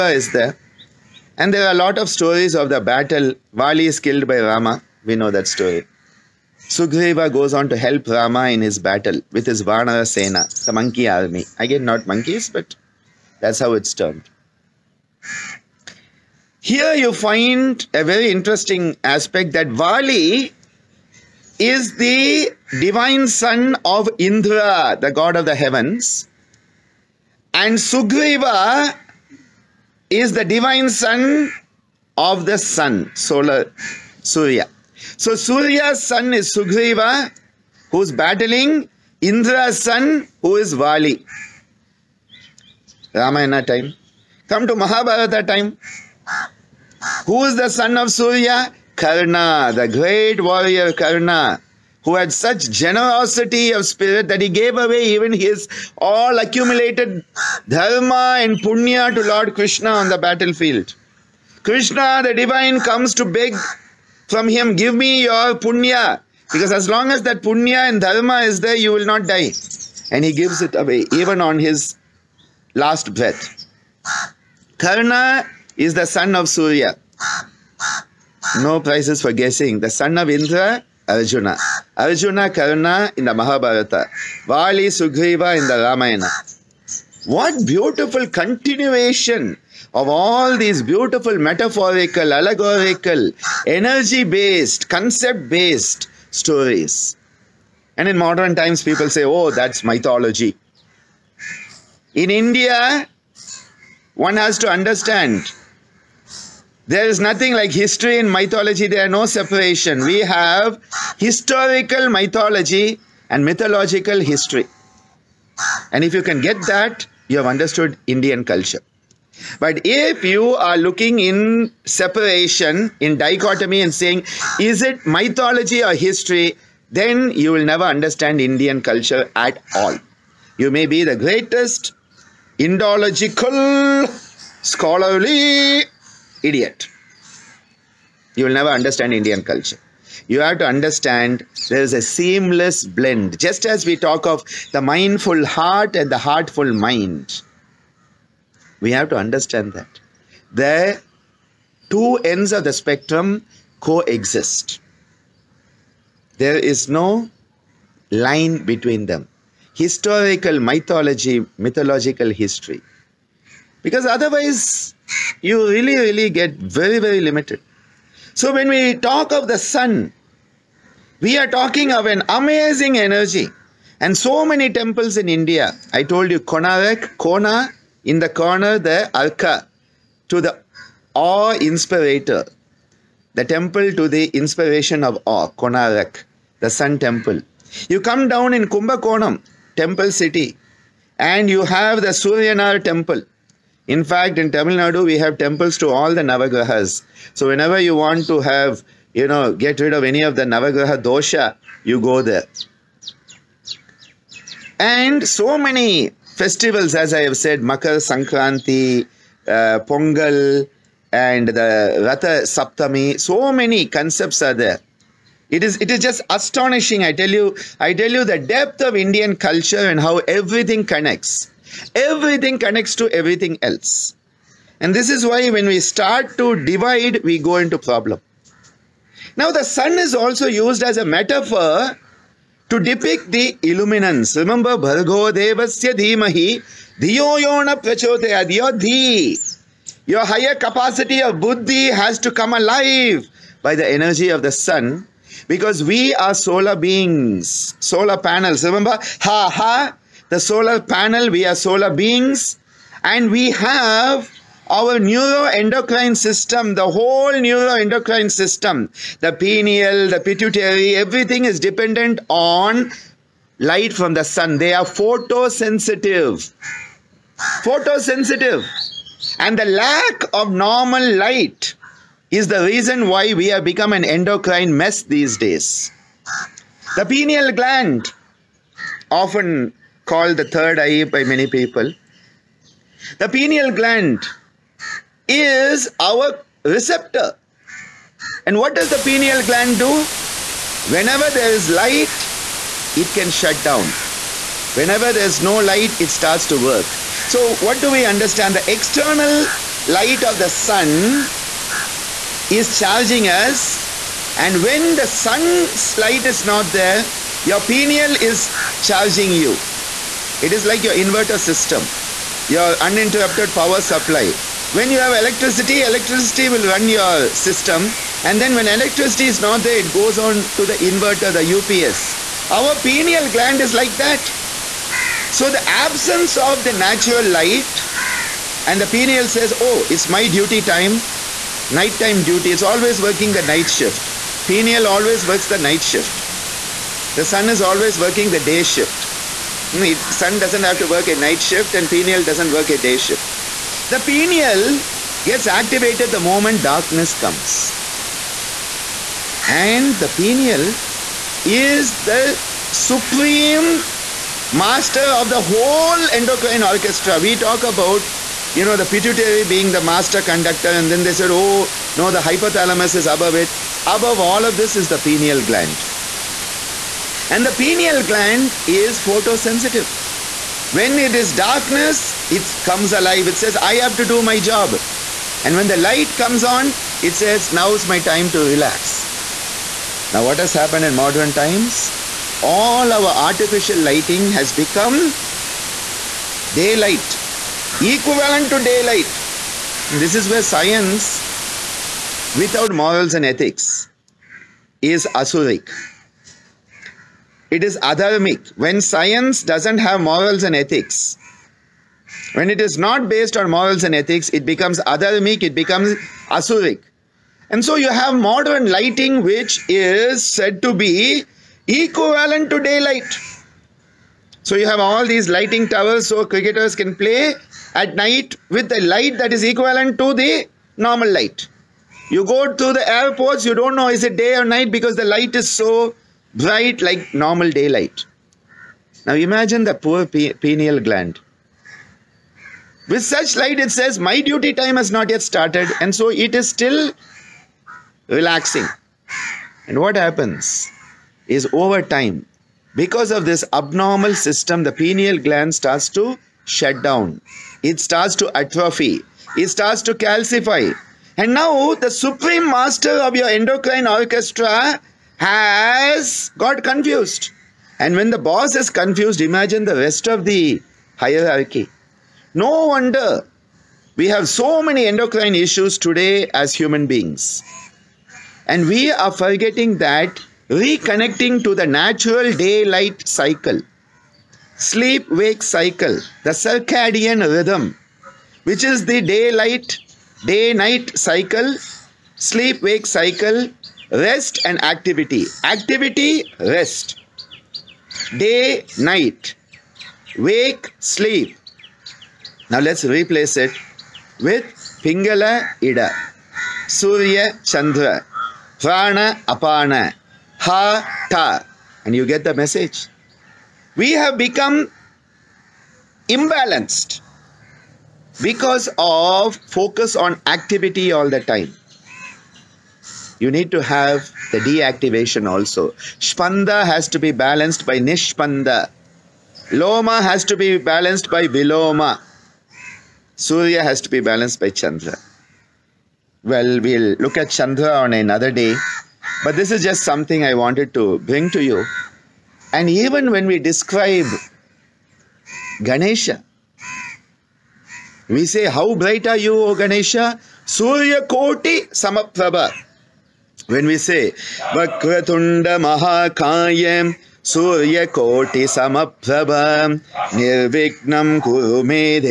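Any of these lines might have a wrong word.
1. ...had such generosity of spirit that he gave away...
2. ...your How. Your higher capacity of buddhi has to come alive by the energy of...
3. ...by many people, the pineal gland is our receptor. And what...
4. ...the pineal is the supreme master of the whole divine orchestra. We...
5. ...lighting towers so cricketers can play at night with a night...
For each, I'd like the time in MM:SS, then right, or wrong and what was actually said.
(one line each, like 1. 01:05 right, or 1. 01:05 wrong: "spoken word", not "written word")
1. 00:52 right
2. 03:58 wrong: "Dhi", not "How"
3. 04:41 right
4. 05:49 wrong: "endocrine", not "divine"
5. 06:55 wrong: "light", not "night".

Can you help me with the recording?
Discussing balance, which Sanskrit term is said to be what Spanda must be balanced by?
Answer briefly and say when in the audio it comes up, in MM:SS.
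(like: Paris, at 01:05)
Nishpanda, at 08:37.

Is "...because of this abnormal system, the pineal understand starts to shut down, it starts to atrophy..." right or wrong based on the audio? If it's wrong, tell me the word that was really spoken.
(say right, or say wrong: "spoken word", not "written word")
wrong: "gland", not "understand".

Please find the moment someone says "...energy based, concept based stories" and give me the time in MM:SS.
01:33.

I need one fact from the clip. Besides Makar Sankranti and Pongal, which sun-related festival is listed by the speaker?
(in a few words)
Ratha Saptami.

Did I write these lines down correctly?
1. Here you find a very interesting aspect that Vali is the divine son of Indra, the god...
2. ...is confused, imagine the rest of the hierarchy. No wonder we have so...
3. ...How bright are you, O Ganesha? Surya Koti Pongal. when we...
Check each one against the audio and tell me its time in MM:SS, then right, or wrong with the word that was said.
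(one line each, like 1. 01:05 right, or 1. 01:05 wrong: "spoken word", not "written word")
1. 00:16 right
2. 07:38 right
3. 08:58 wrong: "Samaprabha", not "Pongal".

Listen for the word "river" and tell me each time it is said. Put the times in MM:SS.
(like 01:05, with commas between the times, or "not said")
not said.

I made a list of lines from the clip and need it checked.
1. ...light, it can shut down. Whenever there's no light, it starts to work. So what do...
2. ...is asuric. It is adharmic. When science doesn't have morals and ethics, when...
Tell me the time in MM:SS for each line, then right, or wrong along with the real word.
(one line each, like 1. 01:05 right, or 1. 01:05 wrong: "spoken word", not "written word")
1. 04:51 right
2. 06:34 right.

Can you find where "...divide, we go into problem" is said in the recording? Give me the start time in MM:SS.
03:46.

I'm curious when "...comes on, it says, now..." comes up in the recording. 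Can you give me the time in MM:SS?
06:16.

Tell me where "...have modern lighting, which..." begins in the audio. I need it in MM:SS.
06:47.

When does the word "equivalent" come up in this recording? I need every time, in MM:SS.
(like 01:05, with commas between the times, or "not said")
06:27, 06:51, 06:59.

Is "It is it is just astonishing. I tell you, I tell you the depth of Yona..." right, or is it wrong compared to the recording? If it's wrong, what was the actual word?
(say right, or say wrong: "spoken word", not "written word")
wrong: "Indian", not "Yona".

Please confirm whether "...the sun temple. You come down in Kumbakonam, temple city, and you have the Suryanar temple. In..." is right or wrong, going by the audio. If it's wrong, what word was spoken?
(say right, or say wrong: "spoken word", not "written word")
right.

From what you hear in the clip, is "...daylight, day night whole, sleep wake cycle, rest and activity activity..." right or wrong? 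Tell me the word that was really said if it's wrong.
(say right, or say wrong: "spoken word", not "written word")
wrong: "cycle", not "whole".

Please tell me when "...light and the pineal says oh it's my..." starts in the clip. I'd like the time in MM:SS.
05:27.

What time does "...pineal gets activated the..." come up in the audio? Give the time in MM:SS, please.
05:44.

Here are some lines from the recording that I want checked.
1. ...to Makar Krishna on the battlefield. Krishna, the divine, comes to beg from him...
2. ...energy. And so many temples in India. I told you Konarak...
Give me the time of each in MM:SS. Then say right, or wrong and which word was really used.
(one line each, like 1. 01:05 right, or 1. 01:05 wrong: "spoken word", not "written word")
1. 00:59 wrong: "Lord", not "Makar"
2. 02:52 right.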